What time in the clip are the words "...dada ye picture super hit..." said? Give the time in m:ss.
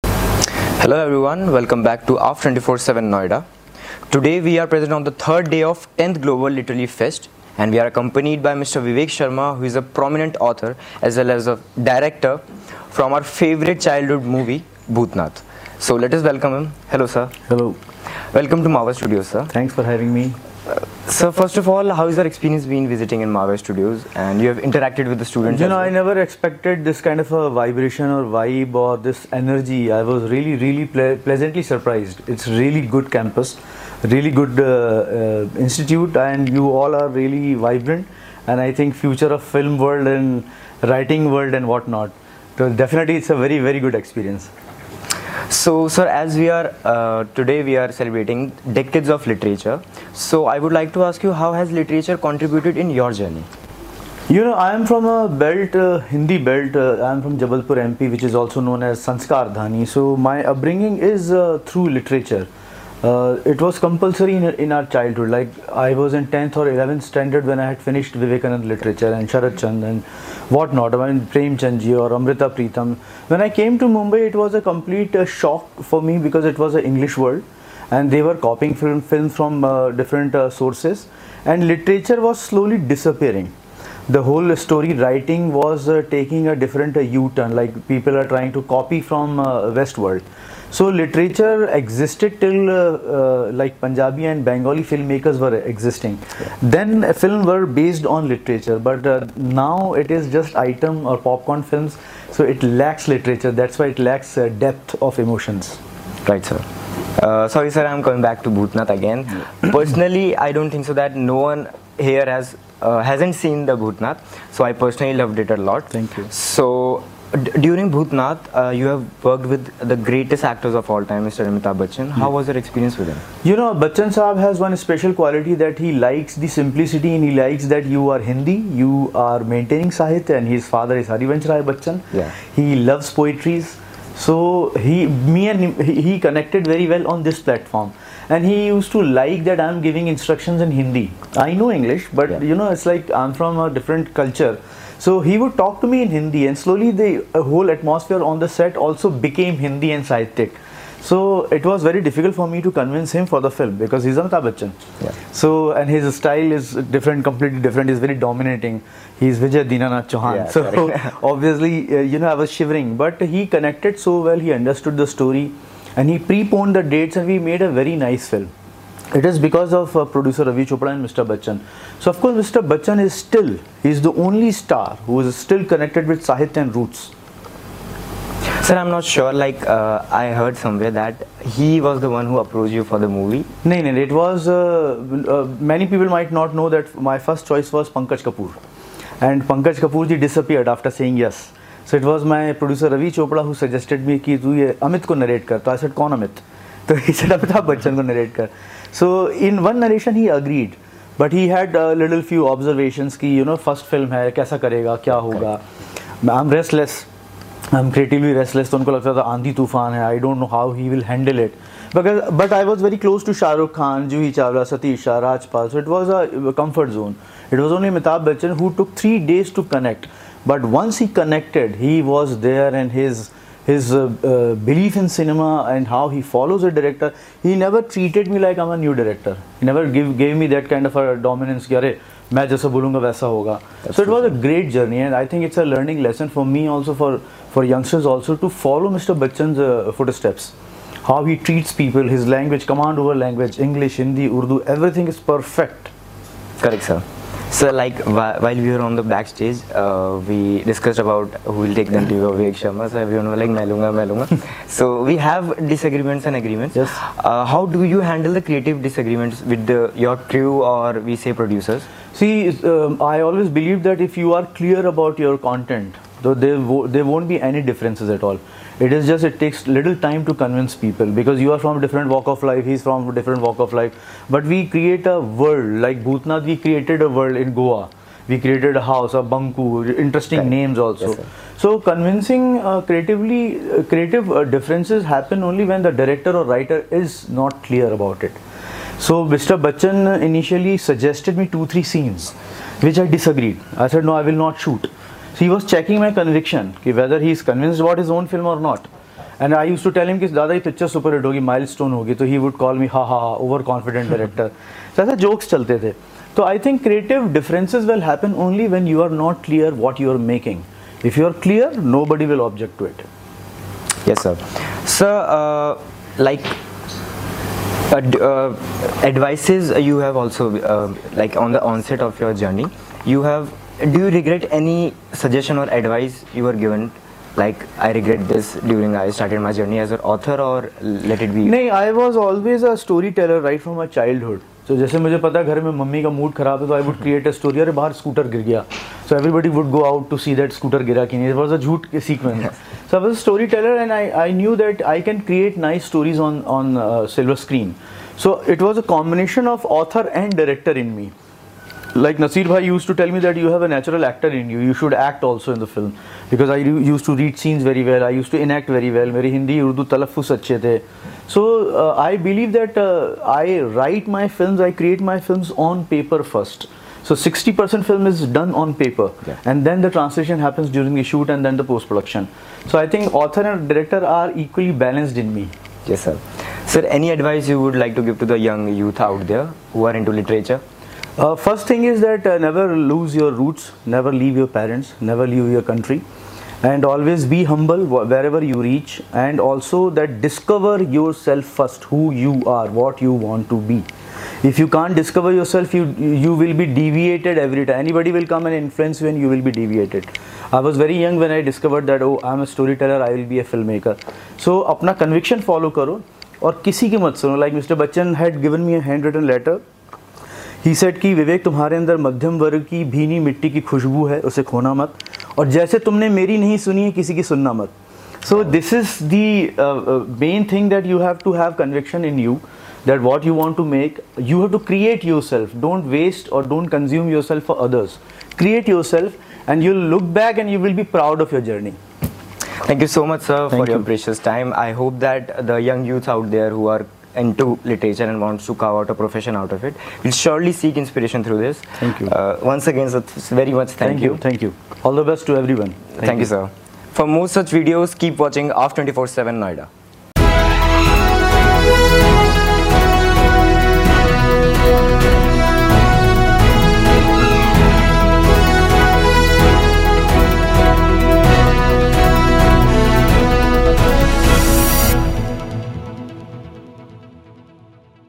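5:00.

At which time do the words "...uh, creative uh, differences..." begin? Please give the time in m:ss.
4:43.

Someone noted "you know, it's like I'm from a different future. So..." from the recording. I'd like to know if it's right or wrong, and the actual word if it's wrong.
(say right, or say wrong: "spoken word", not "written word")
wrong: "culture", not "future".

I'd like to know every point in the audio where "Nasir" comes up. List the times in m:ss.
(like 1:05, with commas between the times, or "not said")
5:52.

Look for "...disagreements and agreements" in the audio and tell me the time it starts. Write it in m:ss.
4:15.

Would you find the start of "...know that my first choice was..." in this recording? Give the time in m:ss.
3:06.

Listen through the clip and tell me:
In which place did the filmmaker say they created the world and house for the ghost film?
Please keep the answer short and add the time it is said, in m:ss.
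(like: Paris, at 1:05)
Goa, at 4:37.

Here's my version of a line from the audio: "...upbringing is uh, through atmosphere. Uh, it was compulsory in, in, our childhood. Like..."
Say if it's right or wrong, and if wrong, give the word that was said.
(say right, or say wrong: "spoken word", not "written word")
wrong: "literature", not "atmosphere".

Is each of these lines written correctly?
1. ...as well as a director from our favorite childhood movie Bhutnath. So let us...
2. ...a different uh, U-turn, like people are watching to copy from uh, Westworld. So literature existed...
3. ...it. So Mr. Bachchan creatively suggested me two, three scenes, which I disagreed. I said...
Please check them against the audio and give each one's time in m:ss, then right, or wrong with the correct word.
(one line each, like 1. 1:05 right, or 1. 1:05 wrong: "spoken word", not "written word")
1. 0:11 right
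2. 1:26 wrong: "trying", not "watching"
3. 4:48 wrong: "initially", not "creatively".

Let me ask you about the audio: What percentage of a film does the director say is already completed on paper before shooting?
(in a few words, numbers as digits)
60%.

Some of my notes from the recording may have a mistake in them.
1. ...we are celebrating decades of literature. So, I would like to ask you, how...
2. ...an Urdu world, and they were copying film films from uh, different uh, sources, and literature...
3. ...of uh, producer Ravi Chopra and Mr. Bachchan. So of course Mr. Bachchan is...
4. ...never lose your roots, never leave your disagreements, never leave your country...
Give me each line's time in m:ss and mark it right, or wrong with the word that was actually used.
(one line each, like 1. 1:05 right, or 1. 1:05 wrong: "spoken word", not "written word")
1. 0:47 right
2. 1:16 wrong: "English", not "Urdu"
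3. 2:49 right
4. 6:22 wrong: "parents", not "disagreements".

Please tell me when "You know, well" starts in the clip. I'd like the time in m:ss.
0:25.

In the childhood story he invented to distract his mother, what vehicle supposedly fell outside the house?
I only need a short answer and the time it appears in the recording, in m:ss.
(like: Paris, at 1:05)
Scooter, at 5:37.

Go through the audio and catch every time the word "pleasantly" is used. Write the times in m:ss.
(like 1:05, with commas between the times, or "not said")
0:31.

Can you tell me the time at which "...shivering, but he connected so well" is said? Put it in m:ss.
2:42.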